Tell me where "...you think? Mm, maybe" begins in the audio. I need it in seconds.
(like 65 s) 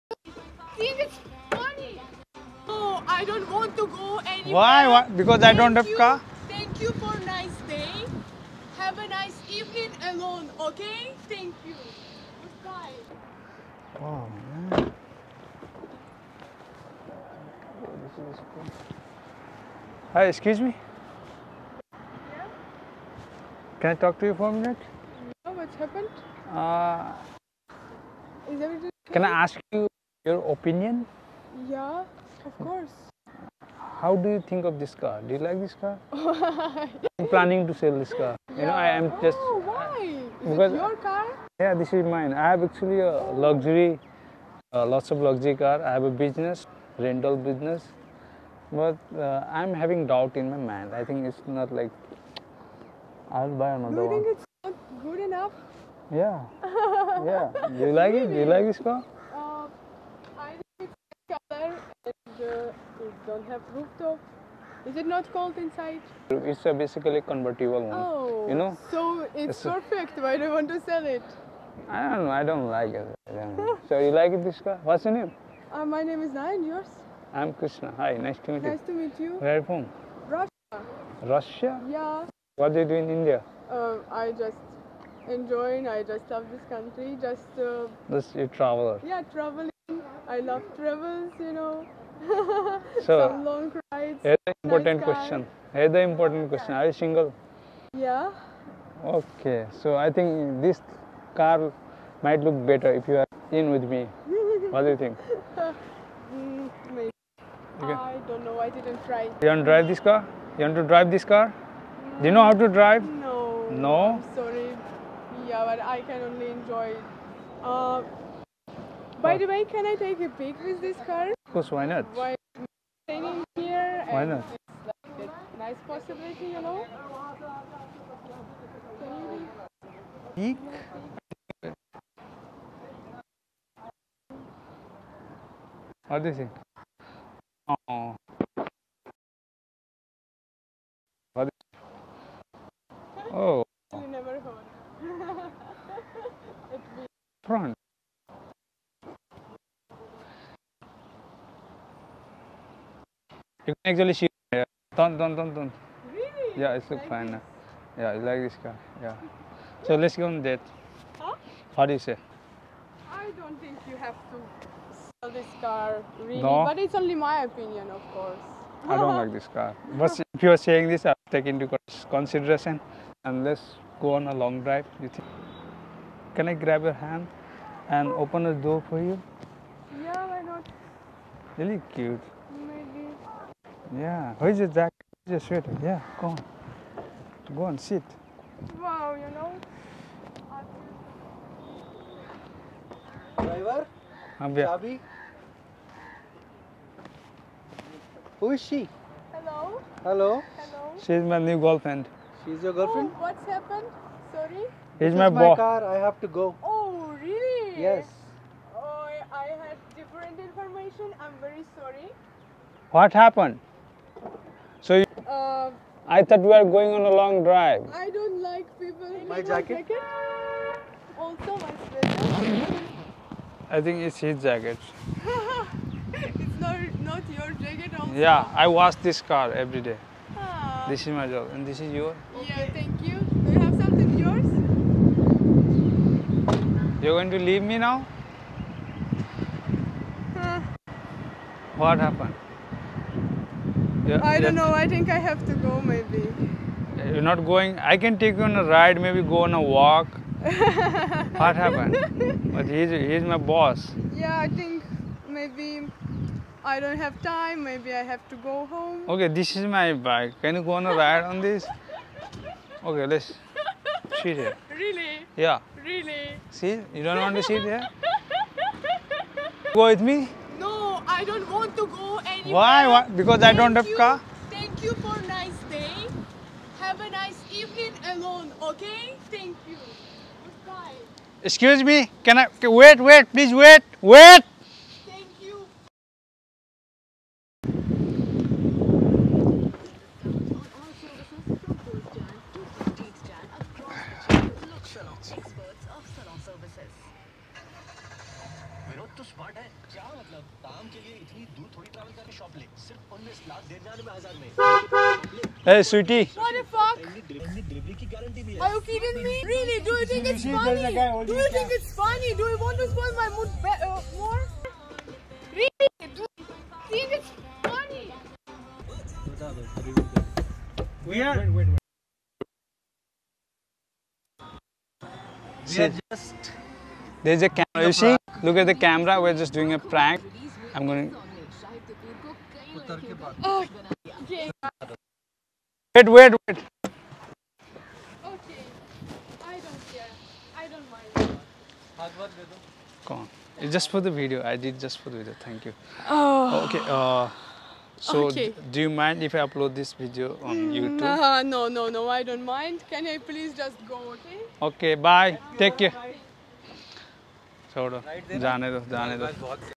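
104 s.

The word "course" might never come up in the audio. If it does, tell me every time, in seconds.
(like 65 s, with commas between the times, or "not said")
32 s, 121 s, 168 s.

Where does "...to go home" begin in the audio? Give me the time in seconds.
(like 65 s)
258 s.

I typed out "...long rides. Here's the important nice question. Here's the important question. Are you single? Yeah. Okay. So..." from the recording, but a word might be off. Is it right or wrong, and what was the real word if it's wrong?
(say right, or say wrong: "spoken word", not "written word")
right.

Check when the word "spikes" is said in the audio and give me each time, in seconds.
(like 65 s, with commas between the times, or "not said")
not said.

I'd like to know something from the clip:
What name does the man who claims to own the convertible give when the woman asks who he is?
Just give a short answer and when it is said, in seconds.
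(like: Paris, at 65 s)
Nayan, at 75 s.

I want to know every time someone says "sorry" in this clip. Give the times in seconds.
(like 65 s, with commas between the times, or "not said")
114 s, 204 s, 211 s.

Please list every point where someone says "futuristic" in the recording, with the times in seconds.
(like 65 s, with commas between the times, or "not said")
not said.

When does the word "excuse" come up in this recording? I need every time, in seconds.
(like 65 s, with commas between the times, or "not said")
20 s, 281 s.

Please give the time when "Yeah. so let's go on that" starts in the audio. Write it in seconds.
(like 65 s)
159 s.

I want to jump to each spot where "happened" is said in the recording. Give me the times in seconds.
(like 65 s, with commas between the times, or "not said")
25 s, 203 s, 213 s, 241 s, 251 s.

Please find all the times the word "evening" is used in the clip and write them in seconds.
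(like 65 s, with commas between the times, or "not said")
9 s, 277 s.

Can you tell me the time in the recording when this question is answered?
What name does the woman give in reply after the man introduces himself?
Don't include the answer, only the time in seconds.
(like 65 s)
77 s.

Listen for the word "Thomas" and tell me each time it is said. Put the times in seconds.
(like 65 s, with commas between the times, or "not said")
not said.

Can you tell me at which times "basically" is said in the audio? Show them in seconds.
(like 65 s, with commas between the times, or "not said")
66 s.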